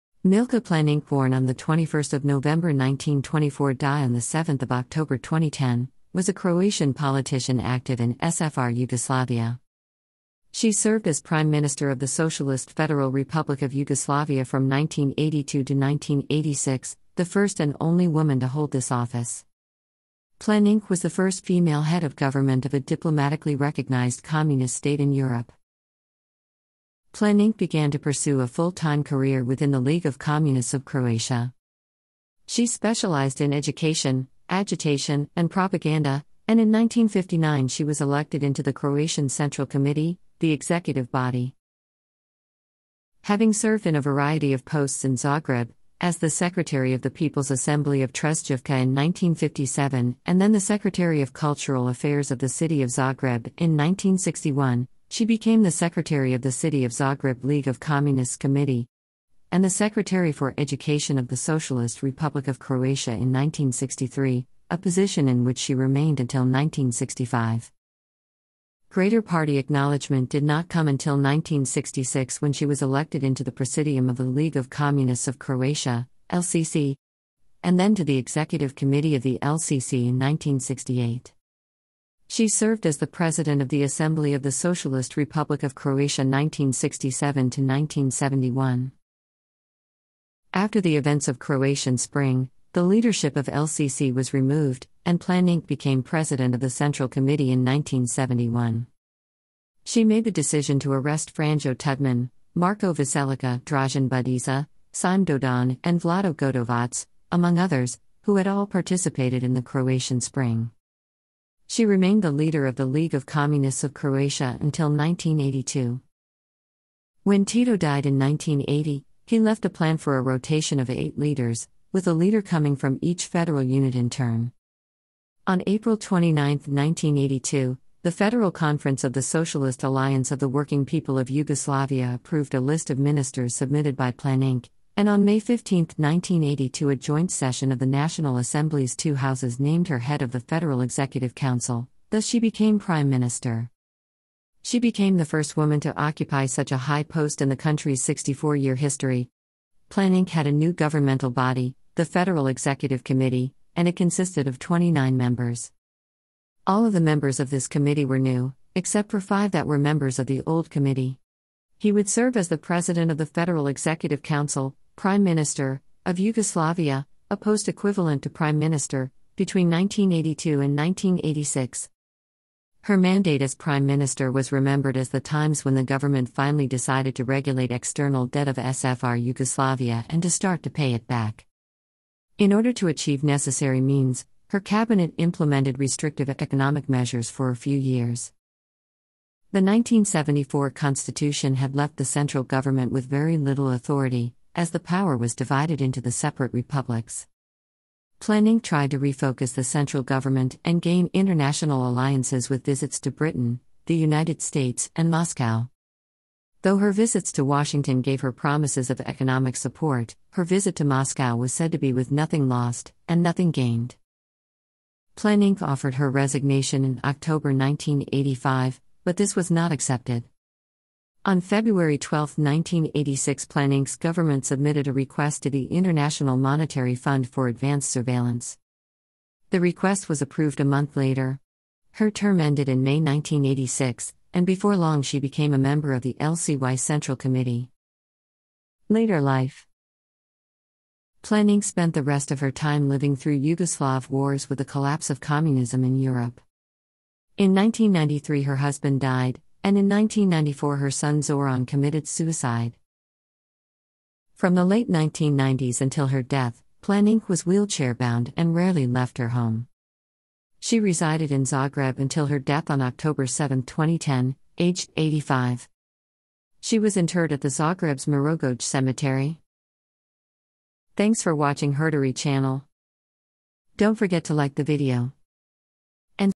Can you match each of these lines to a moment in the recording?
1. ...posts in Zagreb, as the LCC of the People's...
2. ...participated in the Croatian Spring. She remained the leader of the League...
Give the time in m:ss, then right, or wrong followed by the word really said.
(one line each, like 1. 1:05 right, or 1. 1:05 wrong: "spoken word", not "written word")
1. 0:44 wrong: "Secretary", not "LCC"
2. 1:48 right.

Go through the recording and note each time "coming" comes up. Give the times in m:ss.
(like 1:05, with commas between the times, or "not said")
2:02.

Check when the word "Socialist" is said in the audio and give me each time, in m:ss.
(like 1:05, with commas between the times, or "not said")
0:12, 1:01, 1:24, 2:09.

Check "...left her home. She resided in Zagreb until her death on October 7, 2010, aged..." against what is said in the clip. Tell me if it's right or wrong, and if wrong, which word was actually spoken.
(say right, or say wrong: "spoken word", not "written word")
right.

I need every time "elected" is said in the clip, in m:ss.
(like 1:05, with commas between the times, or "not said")
0:37, 1:12.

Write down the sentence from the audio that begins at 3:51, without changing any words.
Her term ended in May 1986, and before long she became a member of the LCY Central Committee.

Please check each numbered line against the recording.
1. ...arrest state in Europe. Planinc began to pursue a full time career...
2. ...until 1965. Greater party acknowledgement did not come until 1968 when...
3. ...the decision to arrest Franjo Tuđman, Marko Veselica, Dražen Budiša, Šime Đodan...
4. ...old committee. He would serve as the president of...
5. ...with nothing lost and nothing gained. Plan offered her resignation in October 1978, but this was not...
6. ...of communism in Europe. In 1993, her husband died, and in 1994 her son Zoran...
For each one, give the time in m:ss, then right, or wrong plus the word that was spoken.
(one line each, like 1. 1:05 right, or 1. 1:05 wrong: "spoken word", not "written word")
1. 0:24 wrong: "communist", not "arrest"
2. 1:06 wrong: "1966", not "1968"
3. 1:40 right
4. 2:40 right
5. 3:31 wrong: "1985", not "1978"
6. 4:05 right.